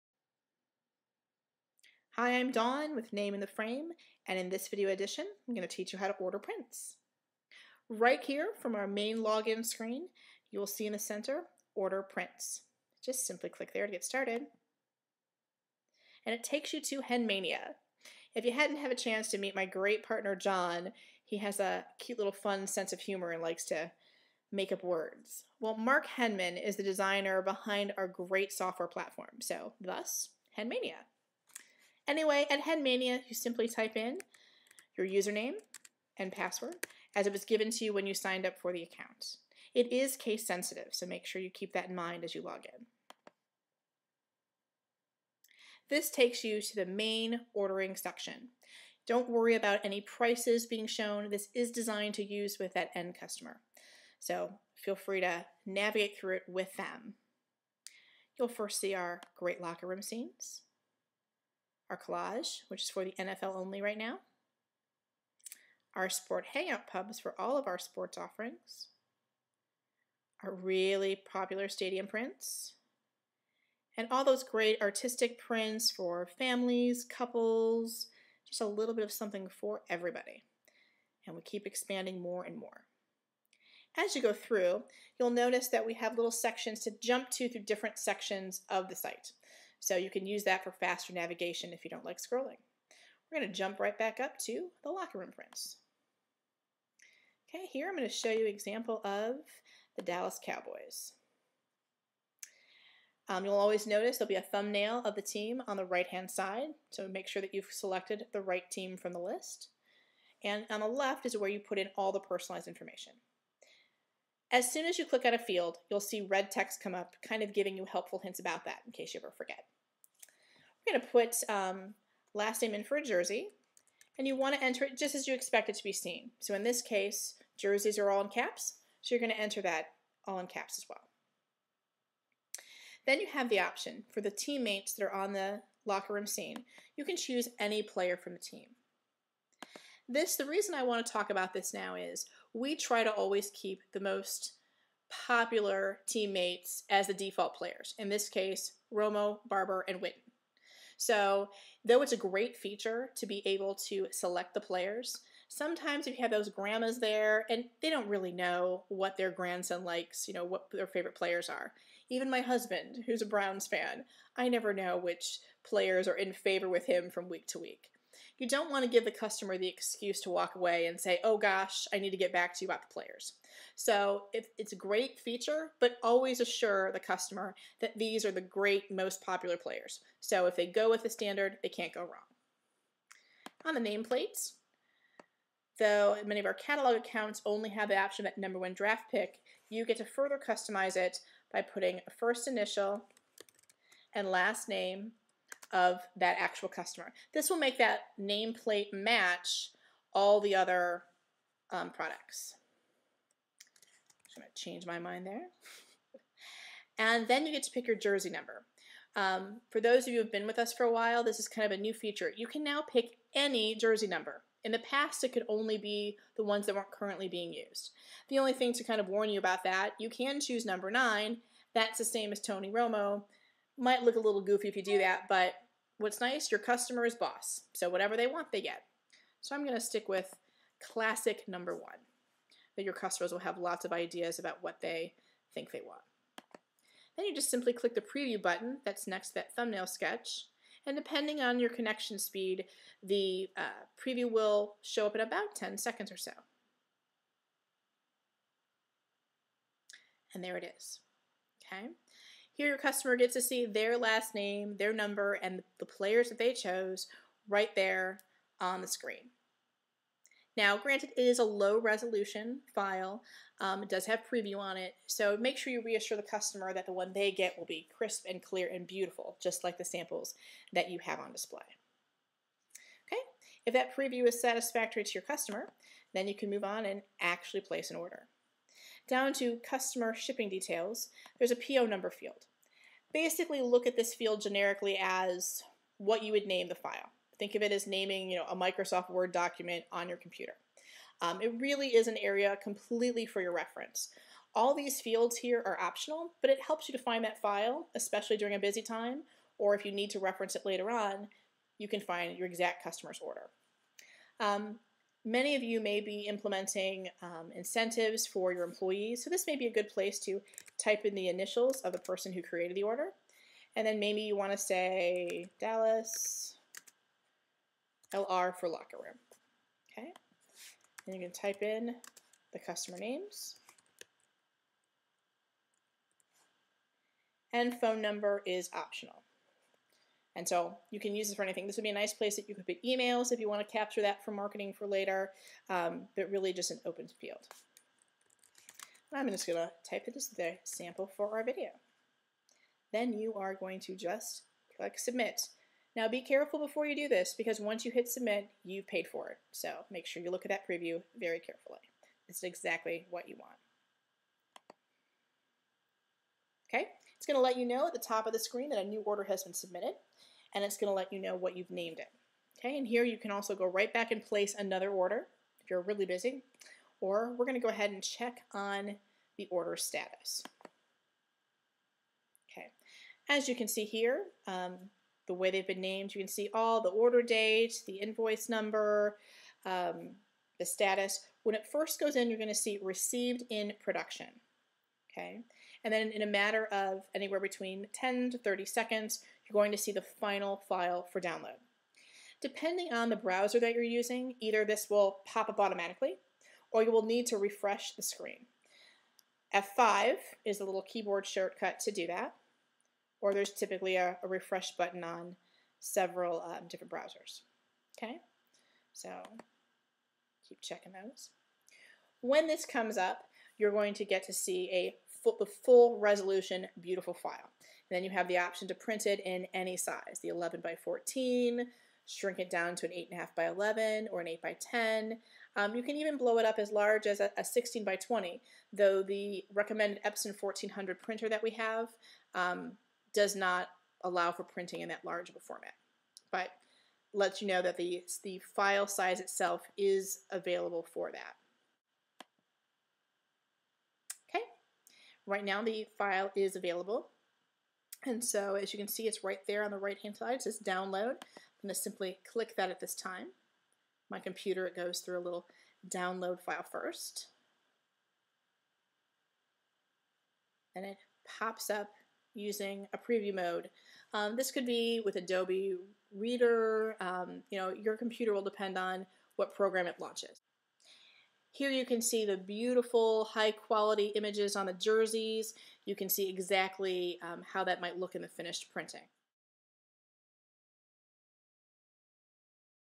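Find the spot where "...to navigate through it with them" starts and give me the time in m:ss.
0:55.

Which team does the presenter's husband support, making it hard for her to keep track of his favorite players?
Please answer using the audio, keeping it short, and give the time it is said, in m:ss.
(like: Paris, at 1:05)
Browns, at 2:43.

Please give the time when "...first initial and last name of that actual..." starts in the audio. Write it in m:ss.
3:12.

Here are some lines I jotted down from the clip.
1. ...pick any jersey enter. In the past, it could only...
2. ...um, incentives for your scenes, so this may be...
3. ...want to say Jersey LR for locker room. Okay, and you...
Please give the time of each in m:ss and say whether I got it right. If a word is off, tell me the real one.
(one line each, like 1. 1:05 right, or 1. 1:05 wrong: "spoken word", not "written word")
1. 3:32 wrong: "number", not "enter"
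2. 5:07 wrong: "employees", not "scenes"
3. 5:14 wrong: "Dallas", not "Jersey".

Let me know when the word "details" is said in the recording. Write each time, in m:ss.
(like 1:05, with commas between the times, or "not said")
4:40.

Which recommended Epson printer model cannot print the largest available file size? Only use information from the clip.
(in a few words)
Epson 1400.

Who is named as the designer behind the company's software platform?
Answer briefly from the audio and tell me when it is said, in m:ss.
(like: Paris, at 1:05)
Mark Henman, at 0:25.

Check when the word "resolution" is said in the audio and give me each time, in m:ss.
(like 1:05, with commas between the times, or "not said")
4:21, 6:55.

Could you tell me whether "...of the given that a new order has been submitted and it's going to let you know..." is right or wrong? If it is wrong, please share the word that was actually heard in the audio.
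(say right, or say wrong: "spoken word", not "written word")
wrong: "screen", not "given".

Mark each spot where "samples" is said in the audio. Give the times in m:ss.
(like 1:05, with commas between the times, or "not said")
4:29, 5:40.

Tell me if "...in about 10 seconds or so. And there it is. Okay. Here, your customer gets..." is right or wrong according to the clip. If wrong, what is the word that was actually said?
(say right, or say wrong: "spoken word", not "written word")
right.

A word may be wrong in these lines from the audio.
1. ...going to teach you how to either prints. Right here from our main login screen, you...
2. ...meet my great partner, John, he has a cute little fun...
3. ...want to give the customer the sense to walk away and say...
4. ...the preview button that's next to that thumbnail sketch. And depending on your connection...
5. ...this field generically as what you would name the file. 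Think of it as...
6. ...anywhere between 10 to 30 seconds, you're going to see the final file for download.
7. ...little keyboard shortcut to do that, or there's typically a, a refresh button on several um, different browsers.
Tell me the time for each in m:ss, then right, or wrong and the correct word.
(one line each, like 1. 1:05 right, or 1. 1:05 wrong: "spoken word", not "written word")
1. 0:05 wrong: "order", not "either"
2. 0:19 right
3. 2:48 wrong: "excuse", not "sense"
4. 3:57 right
5. 4:43 right
6. 6:27 right
7. 6:40 right.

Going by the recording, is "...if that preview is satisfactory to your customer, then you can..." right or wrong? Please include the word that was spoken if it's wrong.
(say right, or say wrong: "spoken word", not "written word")
right.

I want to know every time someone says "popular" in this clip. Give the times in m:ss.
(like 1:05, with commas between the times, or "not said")
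1:11, 2:25, 2:59.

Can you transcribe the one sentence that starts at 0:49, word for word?
Don't worry about any prices being shown.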